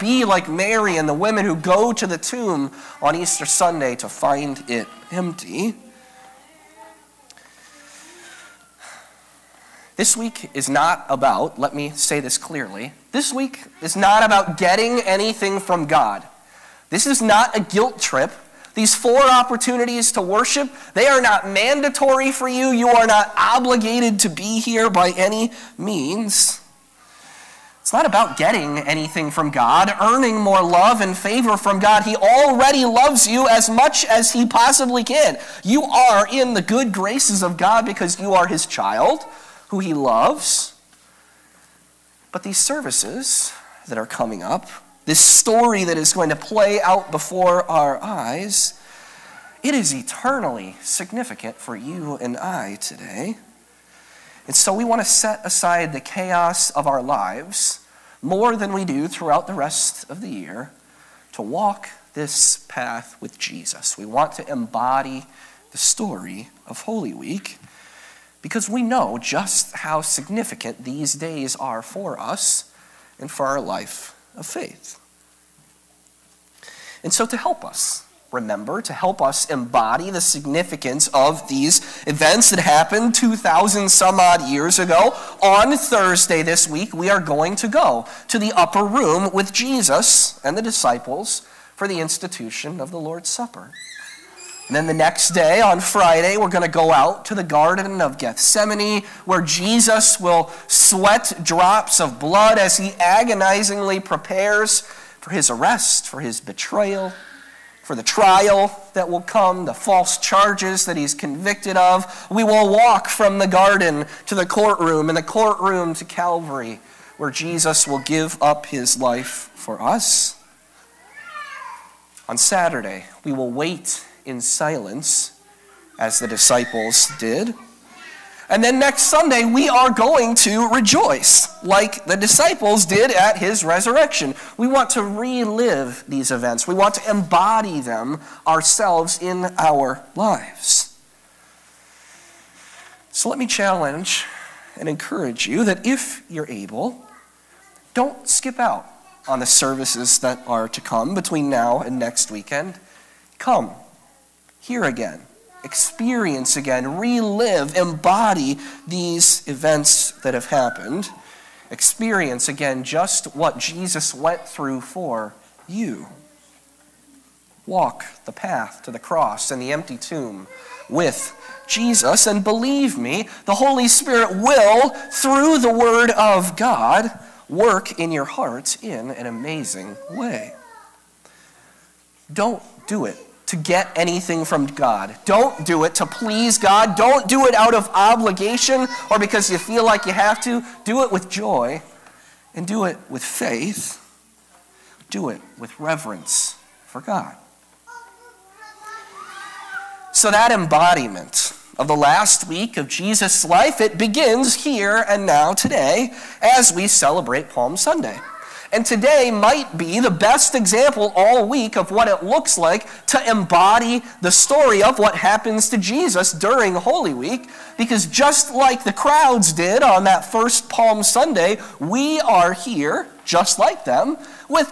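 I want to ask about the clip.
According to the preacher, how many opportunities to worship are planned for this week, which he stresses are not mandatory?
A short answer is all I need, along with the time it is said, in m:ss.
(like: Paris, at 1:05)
4, at 0:18.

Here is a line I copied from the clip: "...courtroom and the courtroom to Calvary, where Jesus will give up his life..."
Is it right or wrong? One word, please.
right.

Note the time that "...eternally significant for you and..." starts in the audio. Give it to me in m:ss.
0:49.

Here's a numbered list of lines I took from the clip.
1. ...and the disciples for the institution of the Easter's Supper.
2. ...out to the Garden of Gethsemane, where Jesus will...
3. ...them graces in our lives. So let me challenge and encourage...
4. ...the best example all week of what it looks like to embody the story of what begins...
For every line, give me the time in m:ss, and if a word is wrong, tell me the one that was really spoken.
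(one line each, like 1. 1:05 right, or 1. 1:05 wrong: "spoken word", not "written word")
1. 1:30 wrong: "Lord", not "Easter"
2. 1:36 right
3. 2:17 wrong: "ourselves", not "graces"
4. 3:30 wrong: "happens", not "begins".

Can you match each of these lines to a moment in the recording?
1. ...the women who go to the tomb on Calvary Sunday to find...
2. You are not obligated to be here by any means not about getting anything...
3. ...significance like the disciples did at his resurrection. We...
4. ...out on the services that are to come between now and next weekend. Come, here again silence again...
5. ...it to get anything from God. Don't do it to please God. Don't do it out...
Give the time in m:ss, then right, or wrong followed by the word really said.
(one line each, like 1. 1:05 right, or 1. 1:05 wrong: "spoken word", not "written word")
1. 0:01 wrong: "Easter", not "Calvary"
2. 0:22 right
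3. 2:10 wrong: "rejoice", not "significance"
4. 2:28 wrong: "experience", not "silence"
5. 3:03 right.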